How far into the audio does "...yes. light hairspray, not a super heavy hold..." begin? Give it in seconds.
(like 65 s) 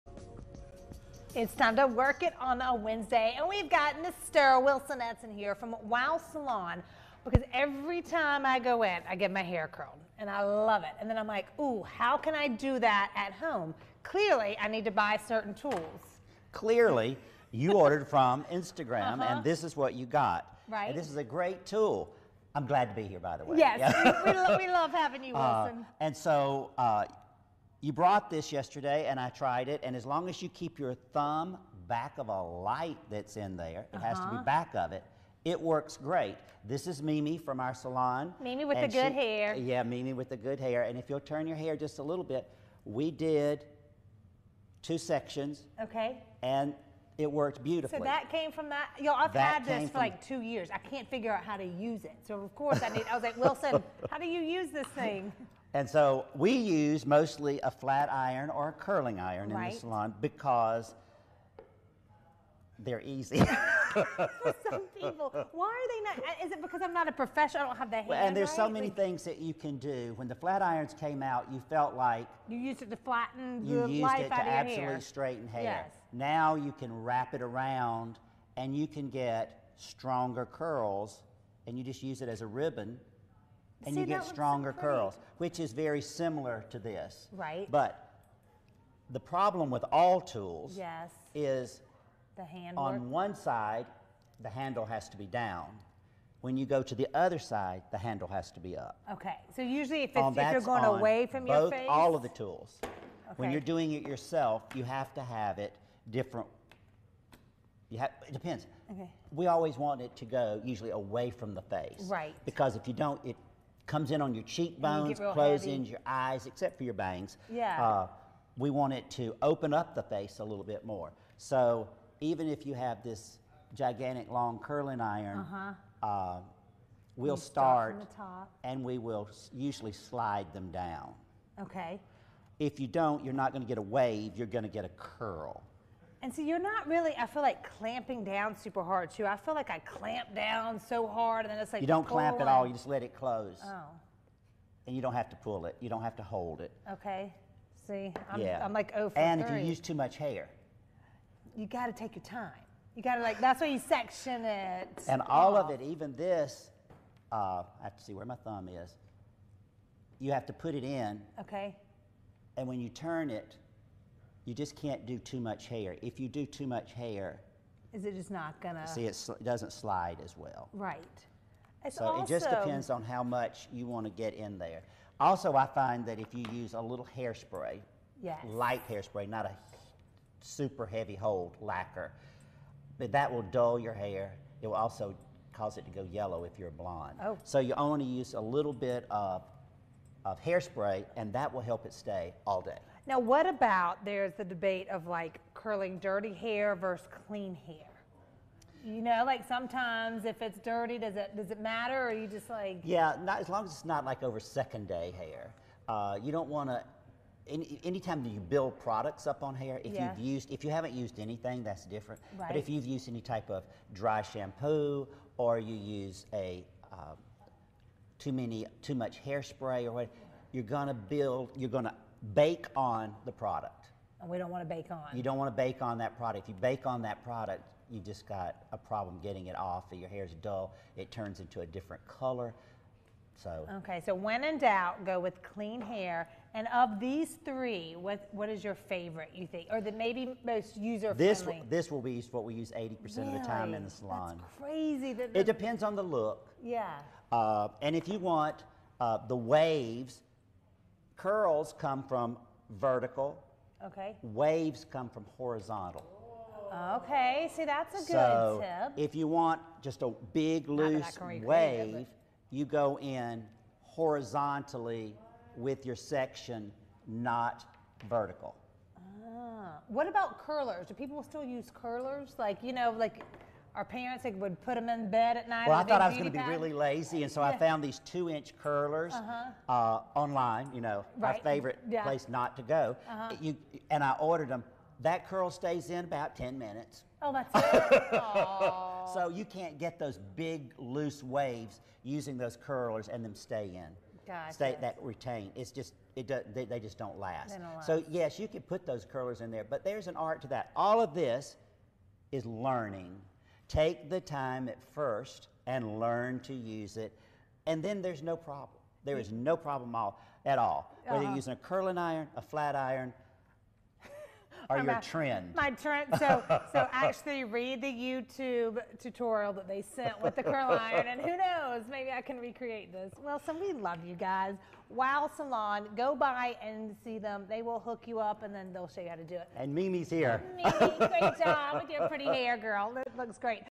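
178 s.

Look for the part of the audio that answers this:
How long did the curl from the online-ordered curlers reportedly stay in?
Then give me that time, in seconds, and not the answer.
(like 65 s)
286 s.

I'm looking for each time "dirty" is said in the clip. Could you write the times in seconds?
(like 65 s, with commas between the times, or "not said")
195 s, 200 s.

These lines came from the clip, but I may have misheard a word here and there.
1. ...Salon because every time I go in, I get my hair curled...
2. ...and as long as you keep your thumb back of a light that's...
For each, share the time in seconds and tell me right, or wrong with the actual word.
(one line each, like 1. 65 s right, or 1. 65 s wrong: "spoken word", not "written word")
1. 6 s right
2. 29 s right.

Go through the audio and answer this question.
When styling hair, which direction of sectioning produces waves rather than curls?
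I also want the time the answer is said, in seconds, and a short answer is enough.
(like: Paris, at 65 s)
Horizontal, at 255 s.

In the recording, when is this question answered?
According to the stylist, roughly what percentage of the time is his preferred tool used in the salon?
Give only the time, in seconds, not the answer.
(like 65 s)
242 s.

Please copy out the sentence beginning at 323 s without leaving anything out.
Well, so we love you guys.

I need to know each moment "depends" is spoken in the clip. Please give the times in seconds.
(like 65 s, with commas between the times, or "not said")
108 s, 172 s, 245 s.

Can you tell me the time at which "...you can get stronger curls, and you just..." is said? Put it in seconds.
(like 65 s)
78 s.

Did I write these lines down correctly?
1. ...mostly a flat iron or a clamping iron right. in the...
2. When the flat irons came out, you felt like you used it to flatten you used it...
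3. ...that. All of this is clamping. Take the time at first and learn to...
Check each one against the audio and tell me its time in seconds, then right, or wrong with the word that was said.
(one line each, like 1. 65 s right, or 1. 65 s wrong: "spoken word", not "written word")
1. 57 s wrong: "curling", not "clamping"
2. 70 s right
3. 300 s wrong: "learning", not "clamping".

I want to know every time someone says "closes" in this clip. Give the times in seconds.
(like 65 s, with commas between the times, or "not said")
115 s, 143 s.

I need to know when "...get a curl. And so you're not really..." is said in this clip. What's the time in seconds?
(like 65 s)
134 s.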